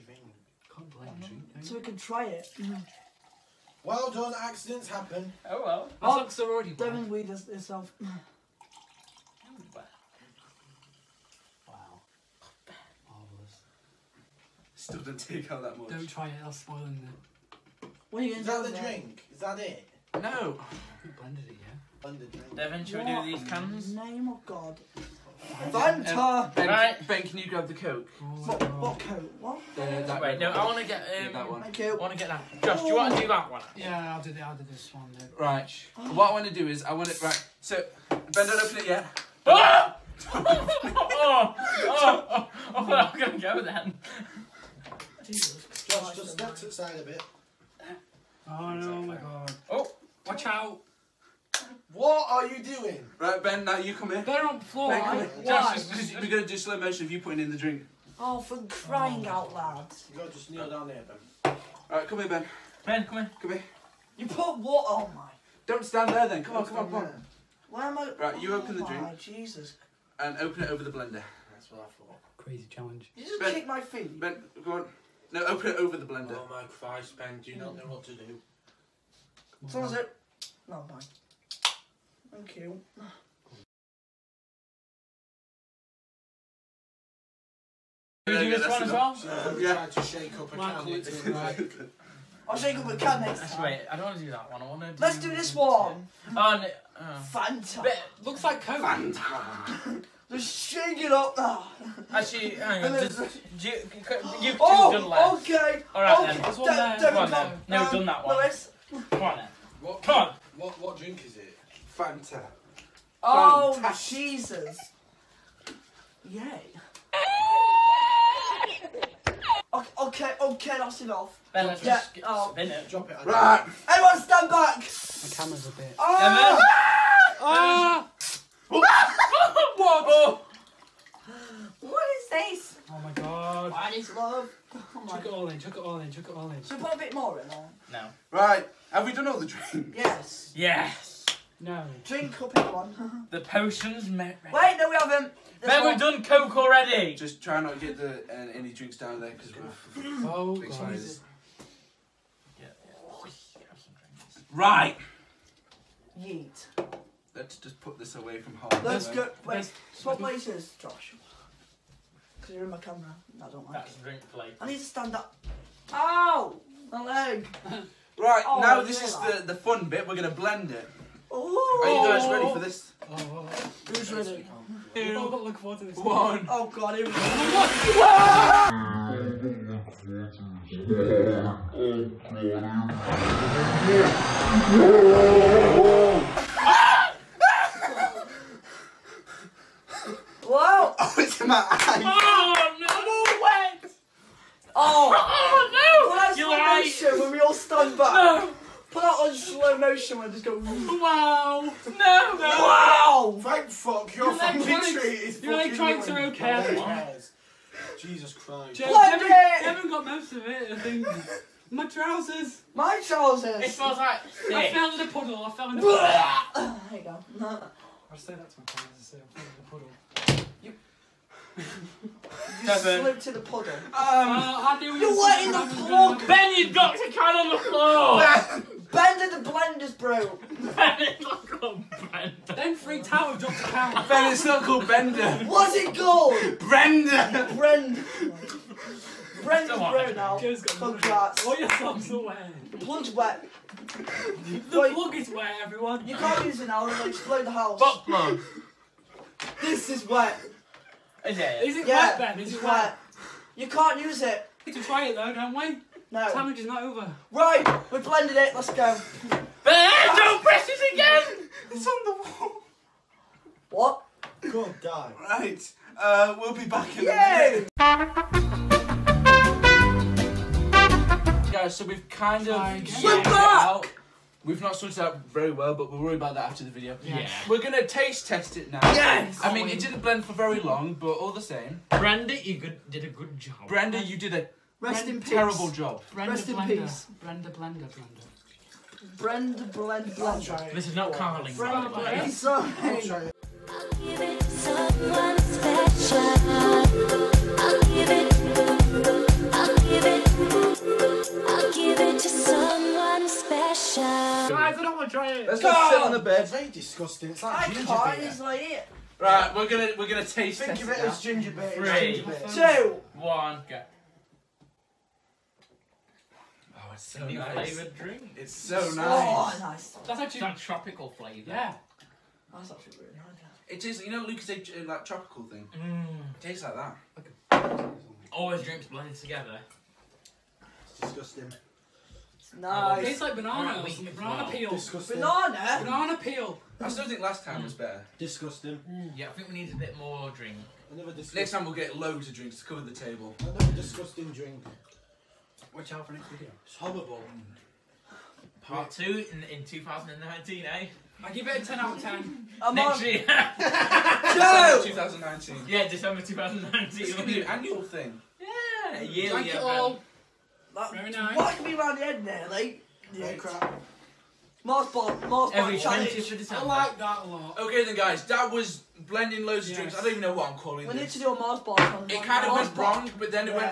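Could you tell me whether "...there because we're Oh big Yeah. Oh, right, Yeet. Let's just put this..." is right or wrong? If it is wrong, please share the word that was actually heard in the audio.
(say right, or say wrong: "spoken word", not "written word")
right.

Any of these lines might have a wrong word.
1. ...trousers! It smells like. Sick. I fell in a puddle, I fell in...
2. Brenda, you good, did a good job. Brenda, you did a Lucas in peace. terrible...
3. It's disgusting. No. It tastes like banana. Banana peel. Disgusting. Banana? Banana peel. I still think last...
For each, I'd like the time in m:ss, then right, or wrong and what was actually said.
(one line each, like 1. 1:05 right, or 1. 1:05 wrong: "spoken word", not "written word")
1. 3:33 right
2. 4:41 wrong: "Rest", not "Lucas"
3. 5:30 right.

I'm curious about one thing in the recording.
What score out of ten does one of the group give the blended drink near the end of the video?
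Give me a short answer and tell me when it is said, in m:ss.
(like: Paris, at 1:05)
10, at 5:51.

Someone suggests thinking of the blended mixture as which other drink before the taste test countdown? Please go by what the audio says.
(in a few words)
ginger beer.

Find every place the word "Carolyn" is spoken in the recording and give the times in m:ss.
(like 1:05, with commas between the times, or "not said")
not said.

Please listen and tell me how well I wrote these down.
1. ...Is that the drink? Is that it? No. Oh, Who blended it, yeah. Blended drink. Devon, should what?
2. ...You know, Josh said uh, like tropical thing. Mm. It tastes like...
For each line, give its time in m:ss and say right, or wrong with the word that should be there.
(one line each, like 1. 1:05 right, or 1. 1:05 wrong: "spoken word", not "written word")
1. 0:18 right
2. 5:24 wrong: "Lucas", not "Josh".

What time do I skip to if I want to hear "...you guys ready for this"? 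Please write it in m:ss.
2:51.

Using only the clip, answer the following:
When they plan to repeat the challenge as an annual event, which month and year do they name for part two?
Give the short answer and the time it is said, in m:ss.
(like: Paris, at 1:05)
December 2019, at 5:55.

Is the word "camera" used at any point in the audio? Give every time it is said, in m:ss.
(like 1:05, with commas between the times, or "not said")
2:05, 2:42.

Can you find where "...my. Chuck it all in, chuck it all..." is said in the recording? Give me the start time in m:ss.
2:15.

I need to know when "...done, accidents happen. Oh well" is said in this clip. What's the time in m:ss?
0:04.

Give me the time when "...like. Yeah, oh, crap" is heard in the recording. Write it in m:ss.
6:02.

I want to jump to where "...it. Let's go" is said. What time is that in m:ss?
4:18.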